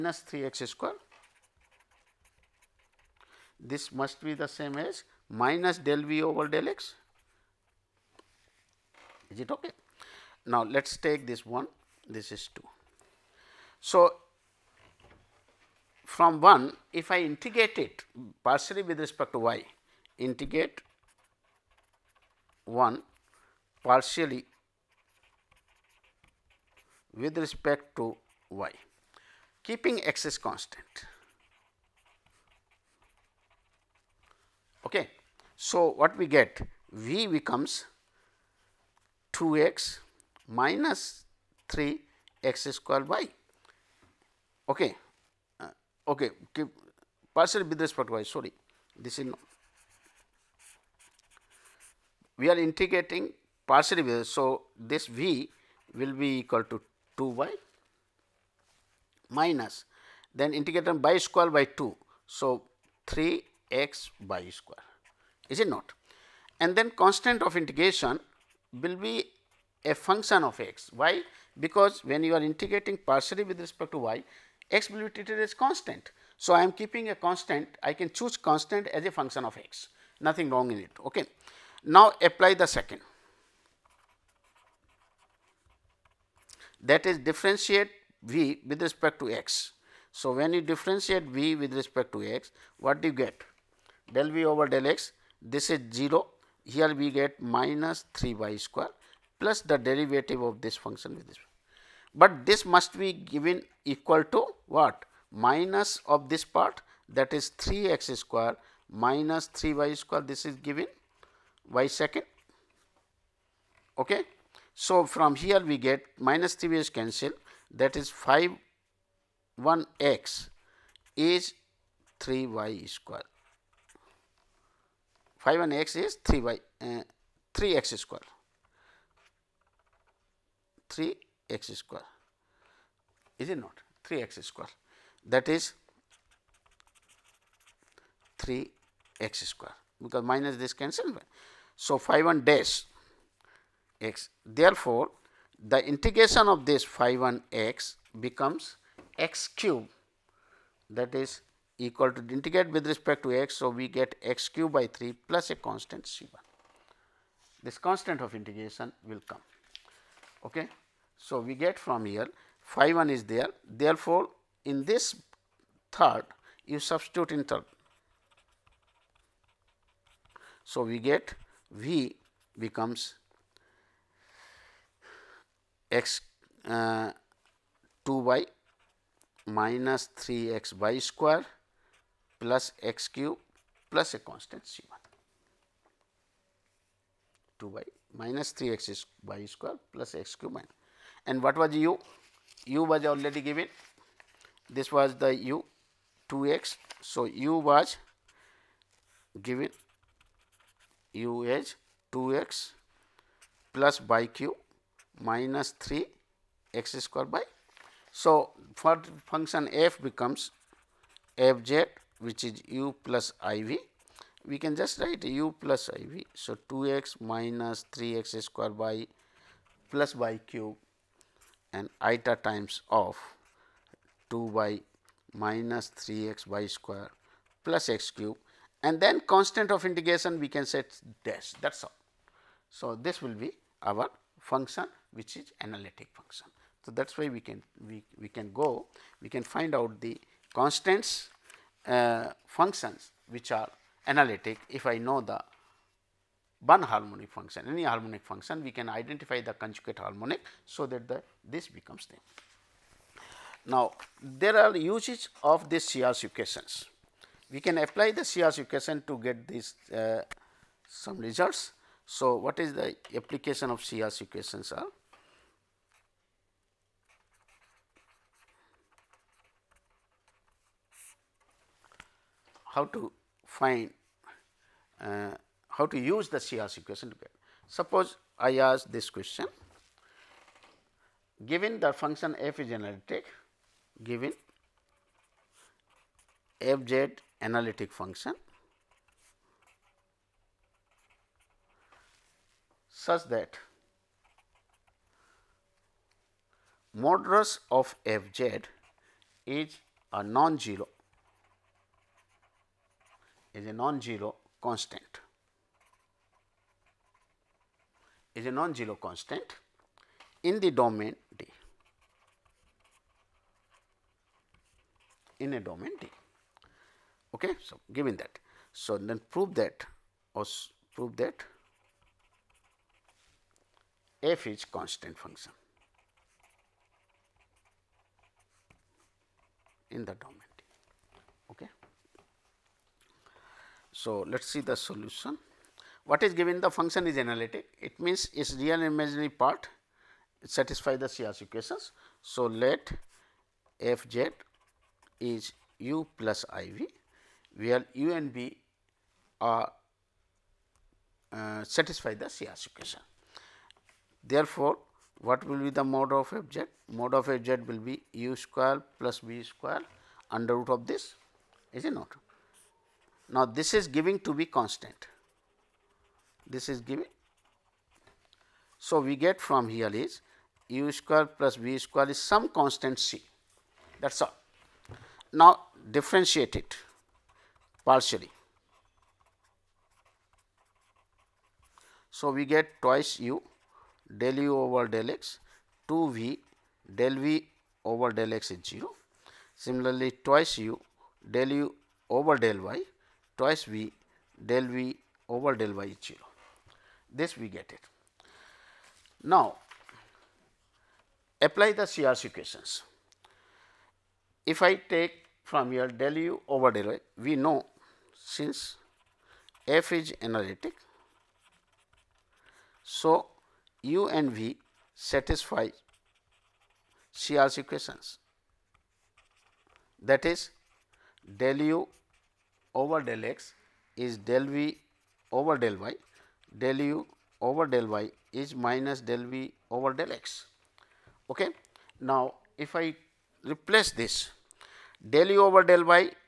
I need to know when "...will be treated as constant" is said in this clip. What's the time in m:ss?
1:14.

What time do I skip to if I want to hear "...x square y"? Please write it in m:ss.
0:42.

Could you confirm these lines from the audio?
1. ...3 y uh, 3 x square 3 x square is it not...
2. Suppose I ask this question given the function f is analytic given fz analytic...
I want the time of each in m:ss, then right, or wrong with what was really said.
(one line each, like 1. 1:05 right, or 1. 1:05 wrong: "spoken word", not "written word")
1. 2:06 right
2. 4:37 right.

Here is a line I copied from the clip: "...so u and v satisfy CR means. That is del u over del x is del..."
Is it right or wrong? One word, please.
wrong.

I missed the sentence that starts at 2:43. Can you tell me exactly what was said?
Therefore, in this third you substitute in third.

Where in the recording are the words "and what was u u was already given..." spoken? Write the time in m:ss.
3:11.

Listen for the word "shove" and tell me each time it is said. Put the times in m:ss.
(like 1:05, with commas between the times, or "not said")
not said.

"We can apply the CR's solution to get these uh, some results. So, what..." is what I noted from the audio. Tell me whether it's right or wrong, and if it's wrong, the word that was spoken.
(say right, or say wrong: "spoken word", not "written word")
wrong: "equation", not "solution".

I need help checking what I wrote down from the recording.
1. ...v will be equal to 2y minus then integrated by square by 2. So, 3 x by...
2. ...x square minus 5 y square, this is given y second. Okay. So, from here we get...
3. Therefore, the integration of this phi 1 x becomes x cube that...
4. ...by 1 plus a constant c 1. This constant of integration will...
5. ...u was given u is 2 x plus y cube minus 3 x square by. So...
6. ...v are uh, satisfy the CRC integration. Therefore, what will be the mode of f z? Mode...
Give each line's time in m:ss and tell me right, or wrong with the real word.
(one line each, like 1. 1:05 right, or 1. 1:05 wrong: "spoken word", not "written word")
1. 0:55 right
2. 1:47 wrong: "3", not "5"
3. 2:24 right
4. 2:34 wrong: "3", not "1"
5. 3:17 right
6. 5:48 wrong: "equation", not "integration".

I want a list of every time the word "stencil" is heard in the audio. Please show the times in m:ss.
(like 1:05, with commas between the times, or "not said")
not said.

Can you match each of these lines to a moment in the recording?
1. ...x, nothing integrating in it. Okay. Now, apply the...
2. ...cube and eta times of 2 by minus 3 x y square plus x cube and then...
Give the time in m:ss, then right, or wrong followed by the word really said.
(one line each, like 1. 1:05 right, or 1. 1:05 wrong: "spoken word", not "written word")
1. 1:19 wrong: "wrong", not "integrating"
2. 3:40 right.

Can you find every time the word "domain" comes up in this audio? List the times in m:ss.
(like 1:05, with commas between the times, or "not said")
5:10, 5:15, 5:30.